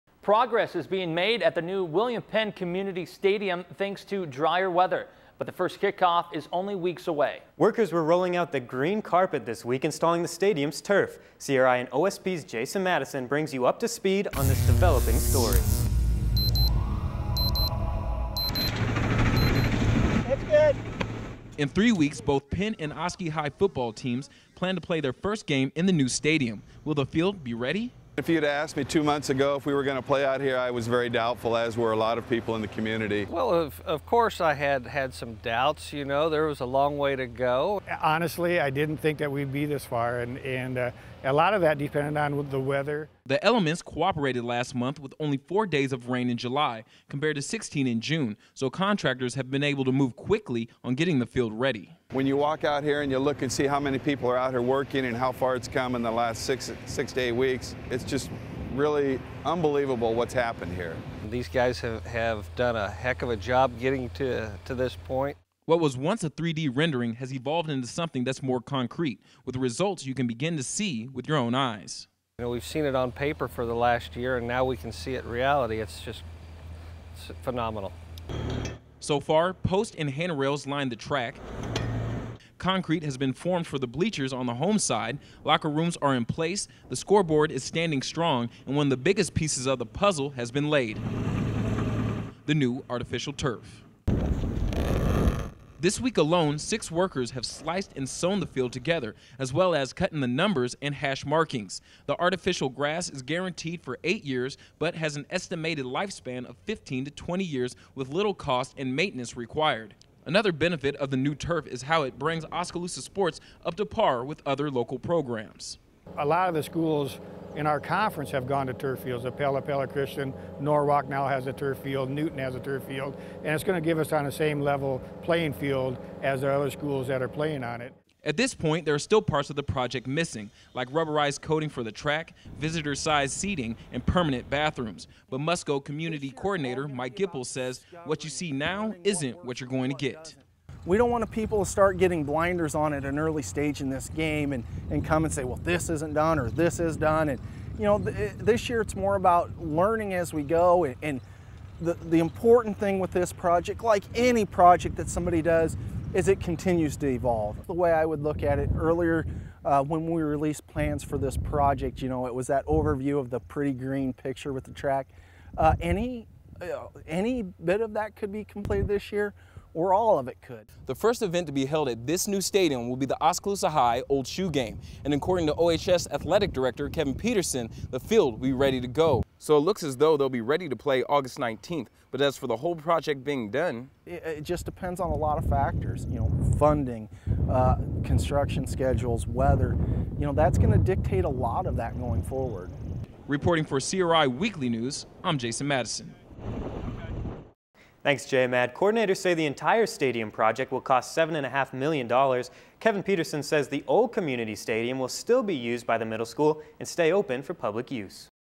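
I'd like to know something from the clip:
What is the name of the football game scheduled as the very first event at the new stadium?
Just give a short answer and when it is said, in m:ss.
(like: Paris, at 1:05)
Old Shoe Game, at 2:54.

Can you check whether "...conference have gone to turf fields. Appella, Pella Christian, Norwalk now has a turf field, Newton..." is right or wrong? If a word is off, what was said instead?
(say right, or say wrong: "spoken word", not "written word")
right.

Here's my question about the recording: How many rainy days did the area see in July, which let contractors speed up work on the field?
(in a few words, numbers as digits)
4.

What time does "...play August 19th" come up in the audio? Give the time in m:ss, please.
3:00.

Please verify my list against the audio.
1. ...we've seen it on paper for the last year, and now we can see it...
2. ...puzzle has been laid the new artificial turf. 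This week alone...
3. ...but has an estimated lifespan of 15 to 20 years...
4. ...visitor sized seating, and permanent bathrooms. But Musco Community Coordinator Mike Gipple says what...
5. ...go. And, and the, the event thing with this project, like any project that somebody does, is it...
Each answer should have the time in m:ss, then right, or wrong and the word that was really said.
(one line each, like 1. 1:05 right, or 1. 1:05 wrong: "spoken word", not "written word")
1. 1:12 right
2. 1:29 right
3. 1:44 right
4. 2:12 right
5. 2:30 wrong: "important", not "event".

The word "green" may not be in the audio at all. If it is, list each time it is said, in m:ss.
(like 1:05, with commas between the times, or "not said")
0:08, 2:43.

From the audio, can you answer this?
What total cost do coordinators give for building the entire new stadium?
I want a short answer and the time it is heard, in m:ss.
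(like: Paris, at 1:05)
$7.5 million, at 3:21.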